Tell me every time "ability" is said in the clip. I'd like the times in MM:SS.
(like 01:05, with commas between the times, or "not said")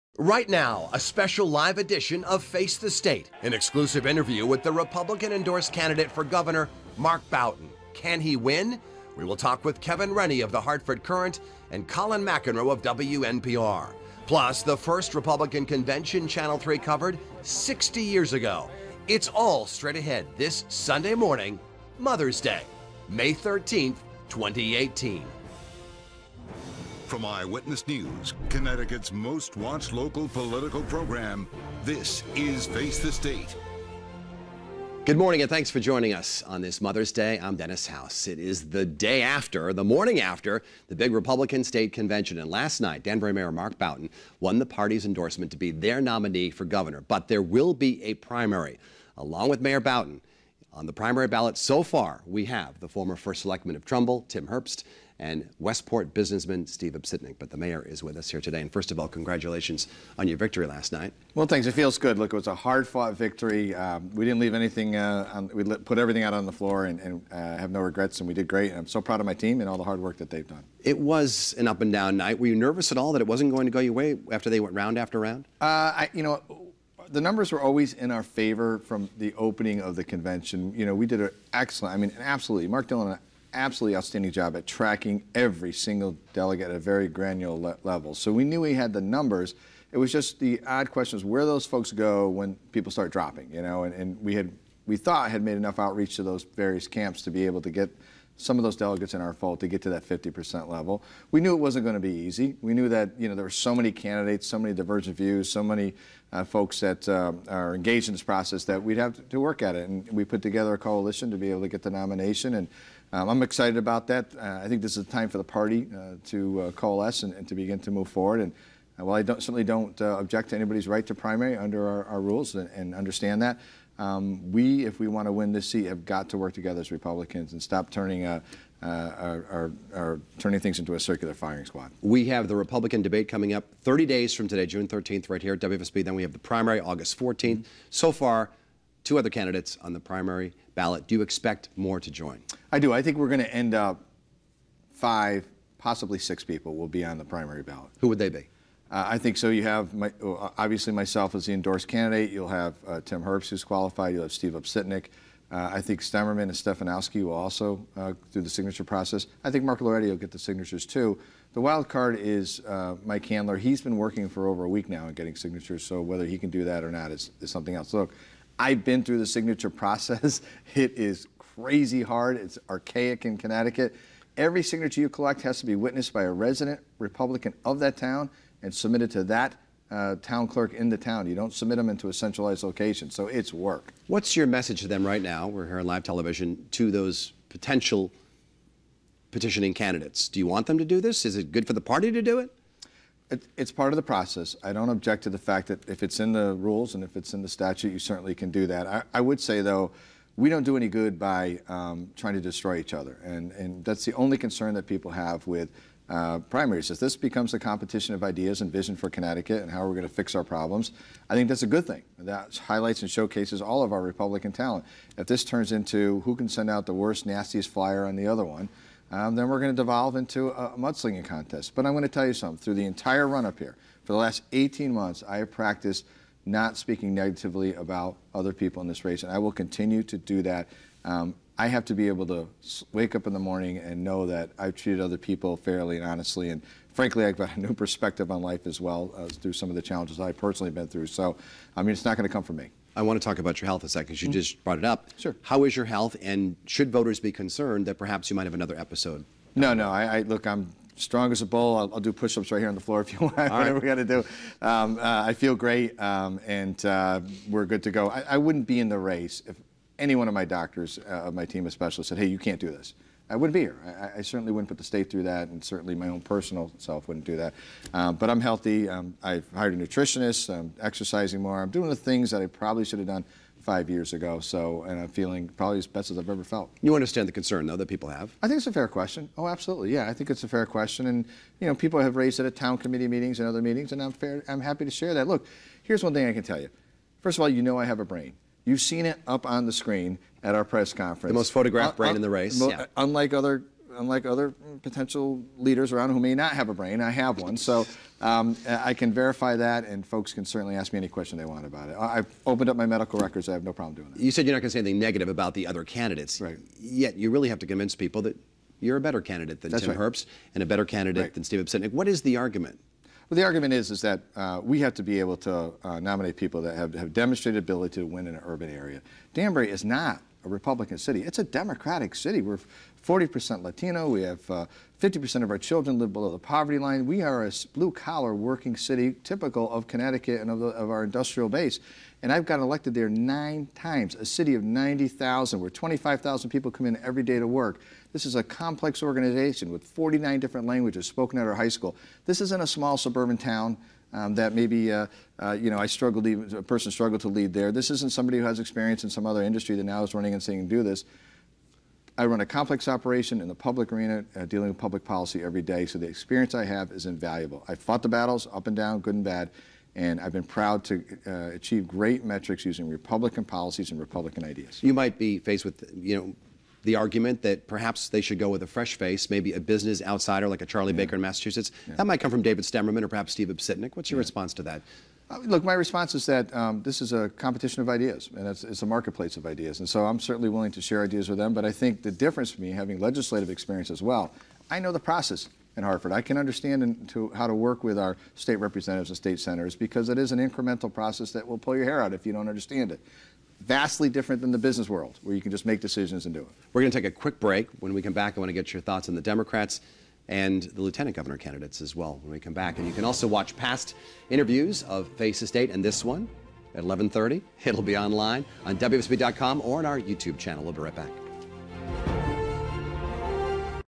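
05:17.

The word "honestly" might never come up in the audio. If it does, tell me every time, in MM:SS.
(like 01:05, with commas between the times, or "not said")
03:56.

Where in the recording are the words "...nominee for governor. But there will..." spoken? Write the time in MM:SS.
00:45.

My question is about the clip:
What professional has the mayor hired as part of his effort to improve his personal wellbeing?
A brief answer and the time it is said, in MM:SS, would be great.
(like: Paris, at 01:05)
A nutritionist, at 04:29.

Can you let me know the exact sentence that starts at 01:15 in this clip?
Uh, I, you know, the numbers were always in our favor from the opening of the convention.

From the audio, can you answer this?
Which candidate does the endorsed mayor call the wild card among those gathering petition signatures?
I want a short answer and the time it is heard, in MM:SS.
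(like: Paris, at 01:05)
Mike Handler, at 02:43.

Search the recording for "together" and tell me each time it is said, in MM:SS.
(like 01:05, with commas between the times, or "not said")
01:50, 02:06.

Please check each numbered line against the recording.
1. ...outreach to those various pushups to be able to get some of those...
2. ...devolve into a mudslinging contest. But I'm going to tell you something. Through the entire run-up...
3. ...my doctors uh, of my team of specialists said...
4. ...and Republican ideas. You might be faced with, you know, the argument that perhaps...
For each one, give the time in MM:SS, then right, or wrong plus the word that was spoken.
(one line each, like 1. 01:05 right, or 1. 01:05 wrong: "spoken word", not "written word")
1. 01:35 wrong: "camps", not "pushups"
2. 03:39 right
3. 04:20 right
4. 06:03 right.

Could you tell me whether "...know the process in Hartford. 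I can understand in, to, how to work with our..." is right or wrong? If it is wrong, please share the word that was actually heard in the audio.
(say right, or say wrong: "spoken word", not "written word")
right.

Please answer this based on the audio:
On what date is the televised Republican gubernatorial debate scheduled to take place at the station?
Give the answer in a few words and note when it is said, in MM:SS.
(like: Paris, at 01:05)
June 13th, at 02:14.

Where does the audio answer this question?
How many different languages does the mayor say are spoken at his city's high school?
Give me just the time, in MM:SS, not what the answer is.
05:39.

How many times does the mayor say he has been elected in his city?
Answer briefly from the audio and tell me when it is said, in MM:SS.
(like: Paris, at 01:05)
9, at 05:33.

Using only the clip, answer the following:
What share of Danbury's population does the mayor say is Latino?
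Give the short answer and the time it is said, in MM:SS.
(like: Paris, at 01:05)
40%, at 05:23.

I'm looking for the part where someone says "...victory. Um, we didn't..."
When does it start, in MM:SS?
01:03.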